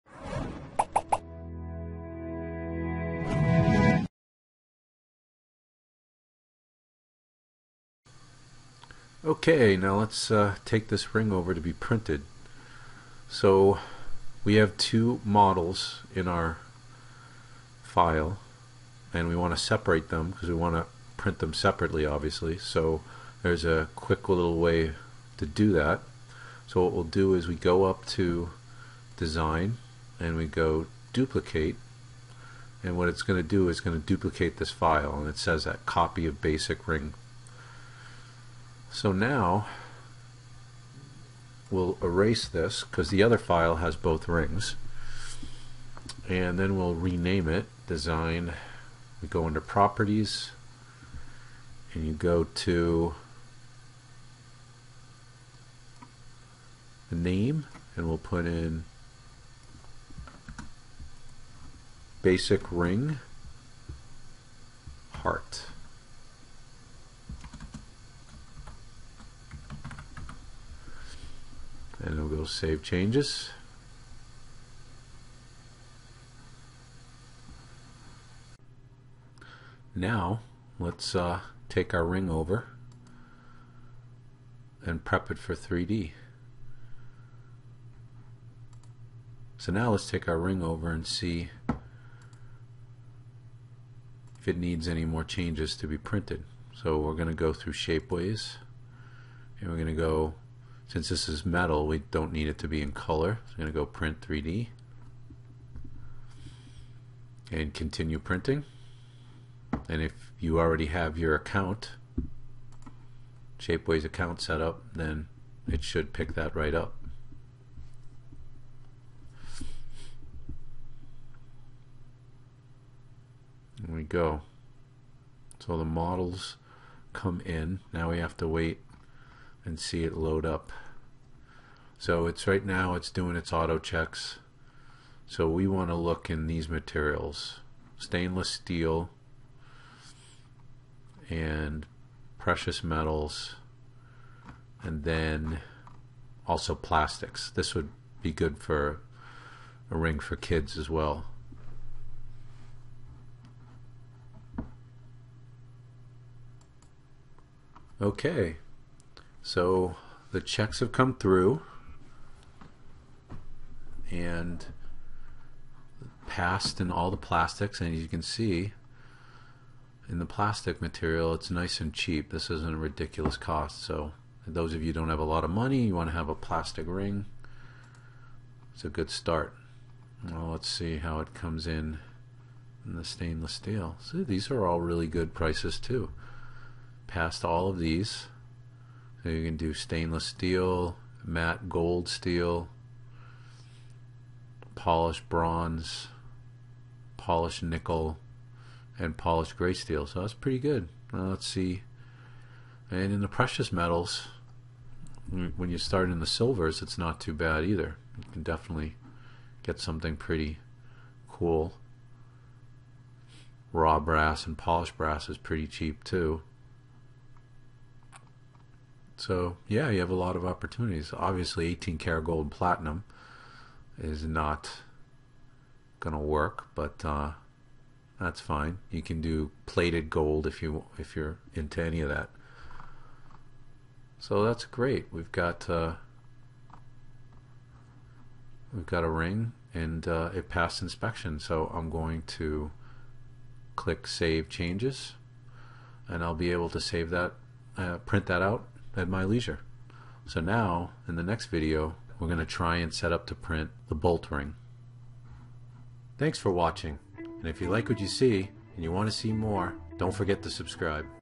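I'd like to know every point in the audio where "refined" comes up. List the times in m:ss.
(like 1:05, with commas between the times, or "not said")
not said.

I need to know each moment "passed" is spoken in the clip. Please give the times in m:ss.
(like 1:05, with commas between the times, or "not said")
2:46, 4:00.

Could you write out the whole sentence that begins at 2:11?
So it's right now it's doing its auto checks.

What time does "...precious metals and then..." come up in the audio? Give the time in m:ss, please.
2:22.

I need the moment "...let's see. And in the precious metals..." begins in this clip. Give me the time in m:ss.
3:21.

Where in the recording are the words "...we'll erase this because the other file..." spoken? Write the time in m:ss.
0:41.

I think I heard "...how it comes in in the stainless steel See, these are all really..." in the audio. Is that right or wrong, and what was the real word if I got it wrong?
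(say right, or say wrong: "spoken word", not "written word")
right.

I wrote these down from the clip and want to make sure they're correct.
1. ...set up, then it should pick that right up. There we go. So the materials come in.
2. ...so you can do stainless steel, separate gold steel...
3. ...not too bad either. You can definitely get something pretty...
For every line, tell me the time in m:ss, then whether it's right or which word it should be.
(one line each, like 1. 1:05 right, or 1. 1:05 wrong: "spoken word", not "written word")
1. 1:54 wrong: "models", not "materials"
2. 3:09 wrong: "matte", not "separate"
3. 3:26 right.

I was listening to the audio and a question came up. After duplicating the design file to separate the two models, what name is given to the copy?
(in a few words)
basic ring heart.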